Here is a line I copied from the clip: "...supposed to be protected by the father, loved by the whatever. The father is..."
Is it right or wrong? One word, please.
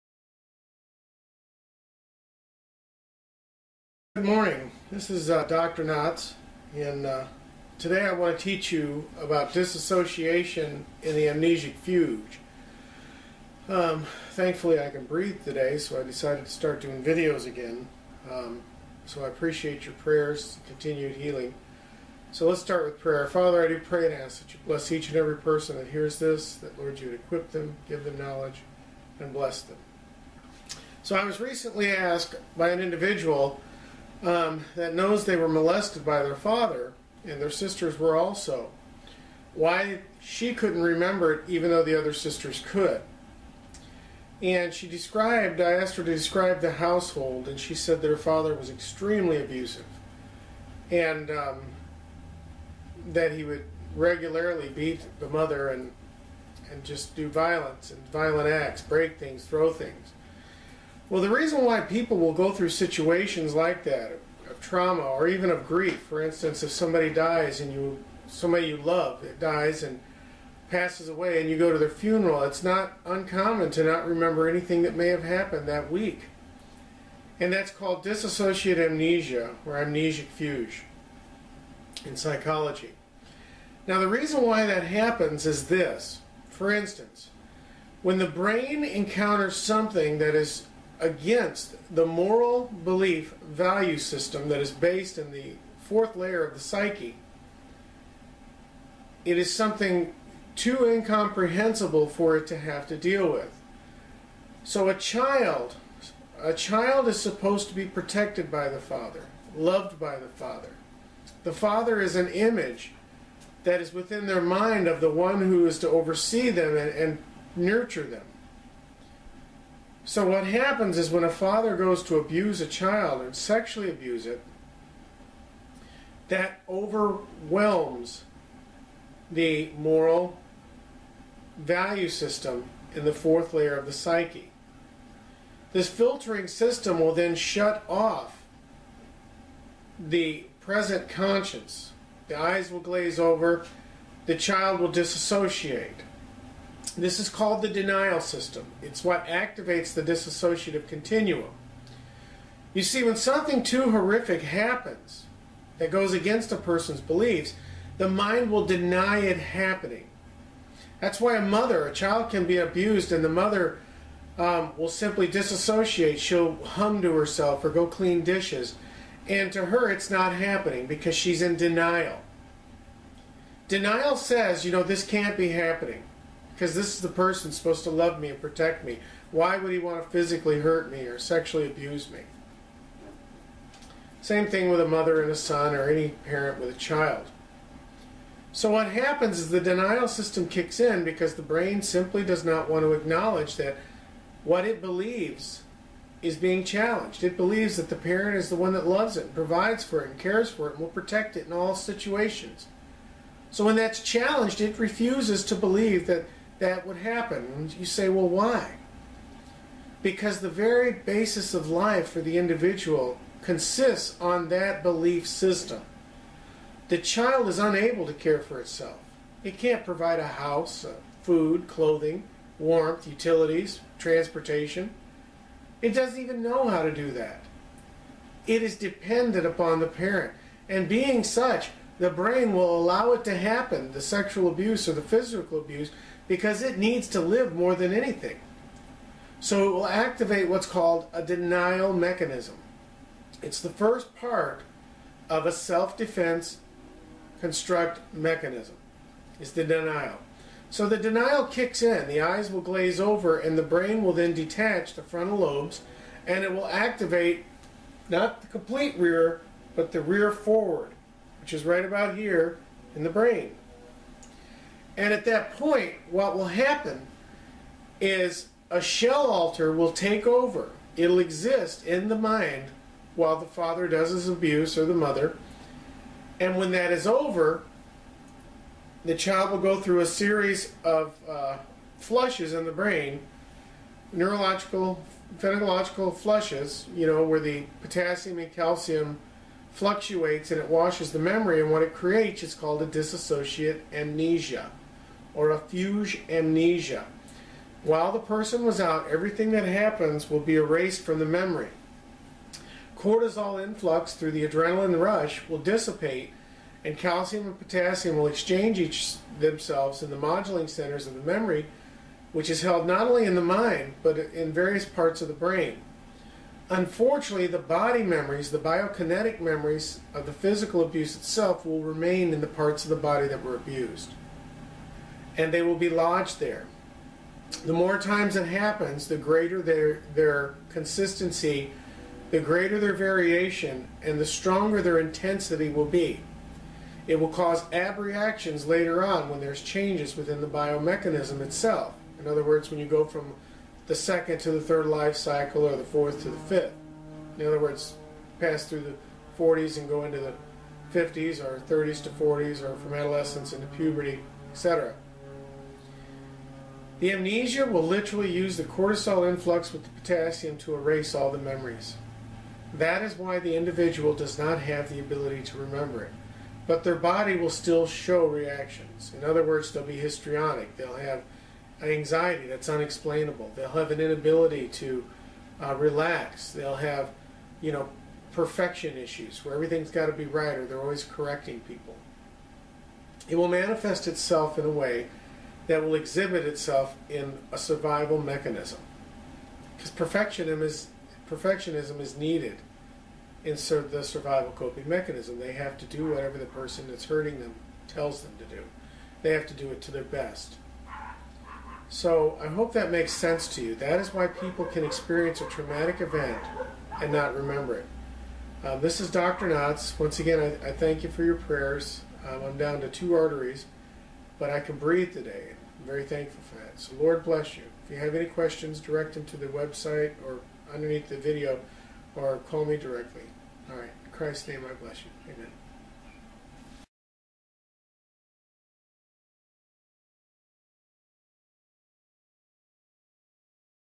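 wrong.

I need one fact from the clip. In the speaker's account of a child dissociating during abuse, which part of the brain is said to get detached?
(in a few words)
the frontal lobes.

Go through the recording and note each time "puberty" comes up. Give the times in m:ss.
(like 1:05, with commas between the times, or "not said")
5:53.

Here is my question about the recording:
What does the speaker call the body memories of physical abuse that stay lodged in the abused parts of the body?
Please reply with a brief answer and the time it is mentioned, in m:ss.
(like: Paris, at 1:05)
biokinetic memories, at 5:18.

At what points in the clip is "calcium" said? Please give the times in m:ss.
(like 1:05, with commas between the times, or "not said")
4:48, 5:06.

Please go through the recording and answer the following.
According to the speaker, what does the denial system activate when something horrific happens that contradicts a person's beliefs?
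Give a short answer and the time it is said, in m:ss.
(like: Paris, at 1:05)
the dissociative continuum, at 2:30.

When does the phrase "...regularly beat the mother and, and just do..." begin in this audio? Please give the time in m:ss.
0:53.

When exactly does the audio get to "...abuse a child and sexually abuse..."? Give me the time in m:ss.
2:02.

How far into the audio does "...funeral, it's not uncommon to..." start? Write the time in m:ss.
1:11.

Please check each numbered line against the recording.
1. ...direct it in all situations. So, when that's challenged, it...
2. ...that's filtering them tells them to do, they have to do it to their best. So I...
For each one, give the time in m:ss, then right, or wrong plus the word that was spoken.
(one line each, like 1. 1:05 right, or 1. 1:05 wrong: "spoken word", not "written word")
1. 3:20 wrong: "protect", not "direct"
2. 6:36 wrong: "hurting", not "filtering".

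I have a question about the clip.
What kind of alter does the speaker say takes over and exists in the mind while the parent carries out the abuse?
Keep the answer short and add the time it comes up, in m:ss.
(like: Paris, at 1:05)
a shell alter, at 4:28.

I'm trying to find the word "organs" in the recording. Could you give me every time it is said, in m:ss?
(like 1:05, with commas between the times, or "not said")
not said.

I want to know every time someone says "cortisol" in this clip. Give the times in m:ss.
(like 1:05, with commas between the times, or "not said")
5:02, 5:58.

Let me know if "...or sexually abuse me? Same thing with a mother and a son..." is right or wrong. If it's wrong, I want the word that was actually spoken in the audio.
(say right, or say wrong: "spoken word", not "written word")
right.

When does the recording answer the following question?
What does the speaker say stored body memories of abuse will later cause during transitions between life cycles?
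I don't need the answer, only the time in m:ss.
5:37.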